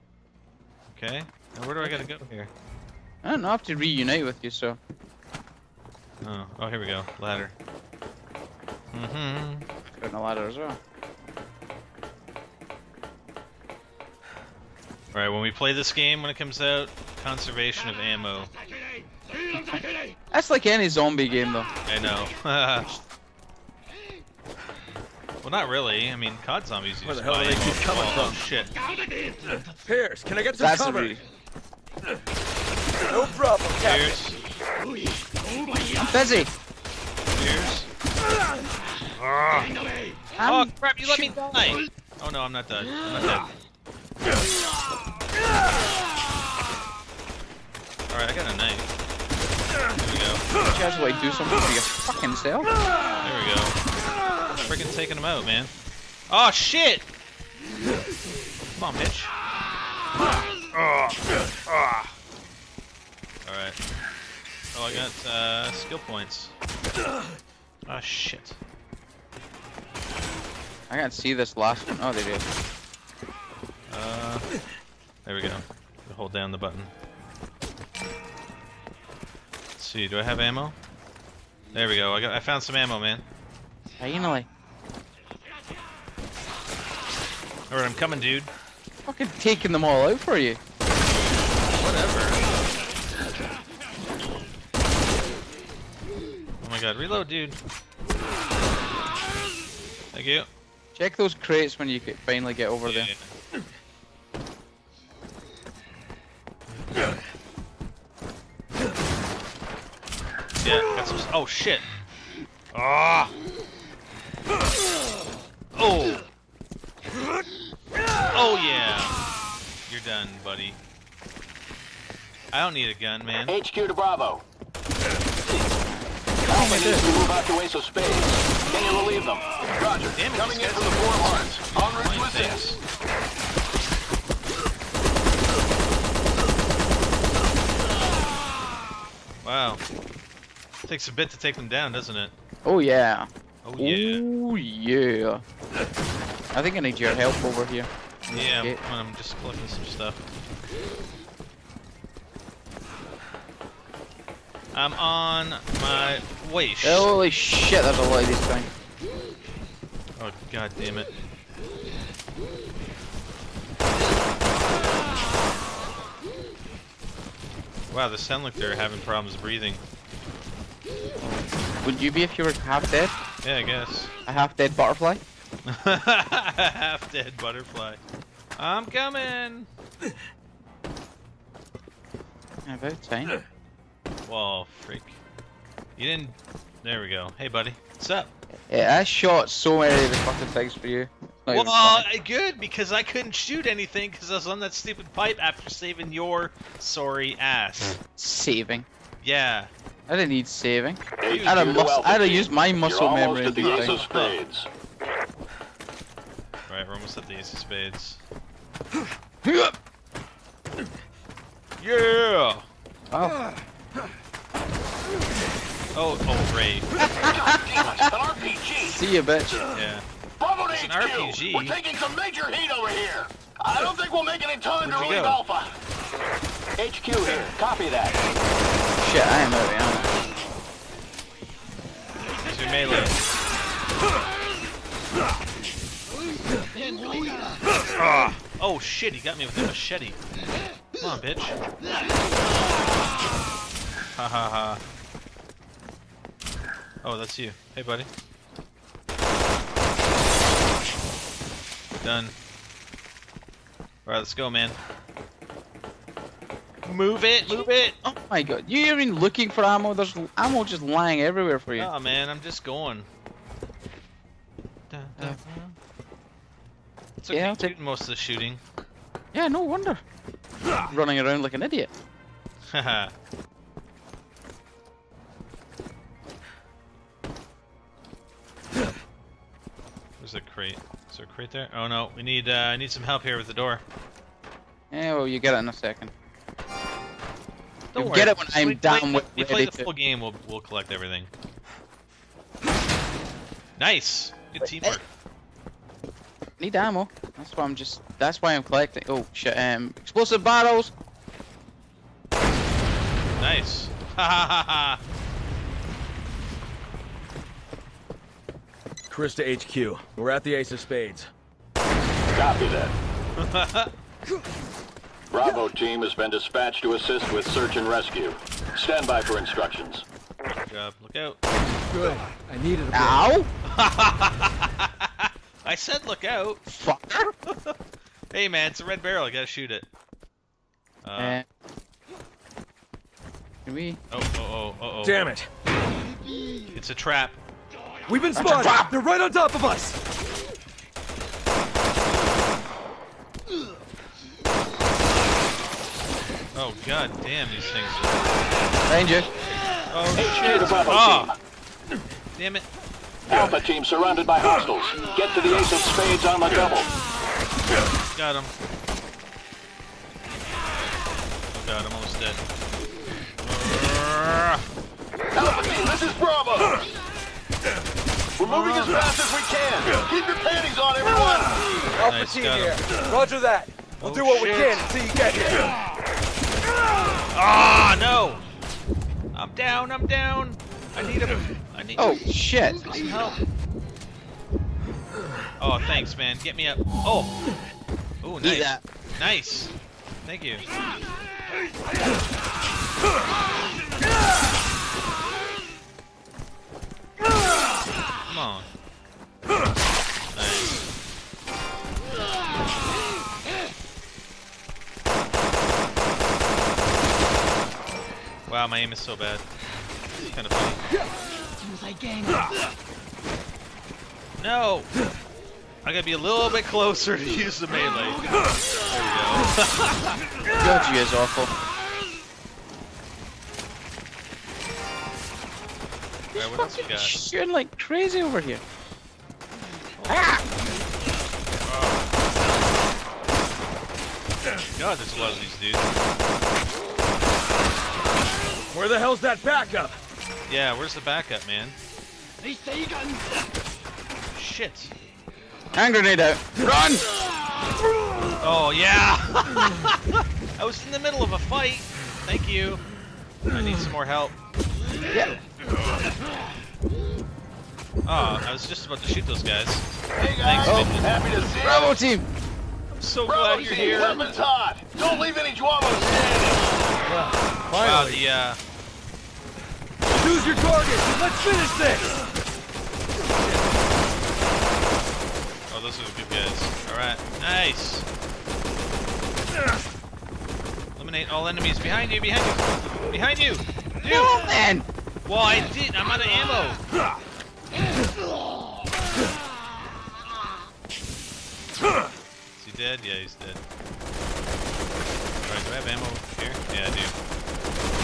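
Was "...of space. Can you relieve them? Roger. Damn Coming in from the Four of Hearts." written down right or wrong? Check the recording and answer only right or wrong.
right.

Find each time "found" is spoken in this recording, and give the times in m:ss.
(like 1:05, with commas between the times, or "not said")
1:22.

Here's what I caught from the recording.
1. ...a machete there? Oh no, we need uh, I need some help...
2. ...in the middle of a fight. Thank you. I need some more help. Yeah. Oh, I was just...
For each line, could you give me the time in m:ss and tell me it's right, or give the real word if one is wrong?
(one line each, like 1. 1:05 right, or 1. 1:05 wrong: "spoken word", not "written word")
1. 4:41 wrong: "crate", not "machete"
2. 7:30 right.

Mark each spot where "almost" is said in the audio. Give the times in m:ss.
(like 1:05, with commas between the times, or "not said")
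3:26, 6:01.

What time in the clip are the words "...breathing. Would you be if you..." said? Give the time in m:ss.
2:49.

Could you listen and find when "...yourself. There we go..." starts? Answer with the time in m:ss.
0:52.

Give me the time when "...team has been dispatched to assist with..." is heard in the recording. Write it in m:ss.
5:15.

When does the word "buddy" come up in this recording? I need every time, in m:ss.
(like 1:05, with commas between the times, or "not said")
3:07, 4:07.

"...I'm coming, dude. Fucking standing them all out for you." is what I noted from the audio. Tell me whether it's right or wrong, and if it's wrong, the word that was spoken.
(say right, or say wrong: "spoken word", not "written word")
wrong: "taking", not "standing".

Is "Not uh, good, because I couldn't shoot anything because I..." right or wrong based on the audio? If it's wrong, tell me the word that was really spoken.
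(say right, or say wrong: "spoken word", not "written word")
right.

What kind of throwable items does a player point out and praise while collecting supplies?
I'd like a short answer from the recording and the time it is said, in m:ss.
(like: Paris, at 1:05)
explosive bottles, at 4:59.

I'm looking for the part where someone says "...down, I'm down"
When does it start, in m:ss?
6:19.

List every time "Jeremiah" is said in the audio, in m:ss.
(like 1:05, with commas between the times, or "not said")
not said.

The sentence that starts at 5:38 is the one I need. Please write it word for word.
They're right on top of us!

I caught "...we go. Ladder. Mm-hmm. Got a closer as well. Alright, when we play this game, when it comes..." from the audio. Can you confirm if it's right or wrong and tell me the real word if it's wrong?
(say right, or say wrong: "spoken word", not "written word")
wrong: "ladder", not "closer".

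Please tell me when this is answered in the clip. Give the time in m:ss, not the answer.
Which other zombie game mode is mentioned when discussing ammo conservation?
0:26.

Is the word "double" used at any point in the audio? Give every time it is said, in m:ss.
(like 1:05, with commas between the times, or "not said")
5:56.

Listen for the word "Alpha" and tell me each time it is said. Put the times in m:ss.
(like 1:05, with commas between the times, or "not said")
3:45, 5:53, 6:05, 6:11.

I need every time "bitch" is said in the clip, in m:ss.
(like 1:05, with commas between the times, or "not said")
0:58, 3:39, 4:01.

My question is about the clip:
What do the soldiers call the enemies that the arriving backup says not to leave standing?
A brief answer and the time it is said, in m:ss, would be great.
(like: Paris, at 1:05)
J'avo, at 7:45.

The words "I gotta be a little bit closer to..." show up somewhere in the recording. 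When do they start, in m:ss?
6:55.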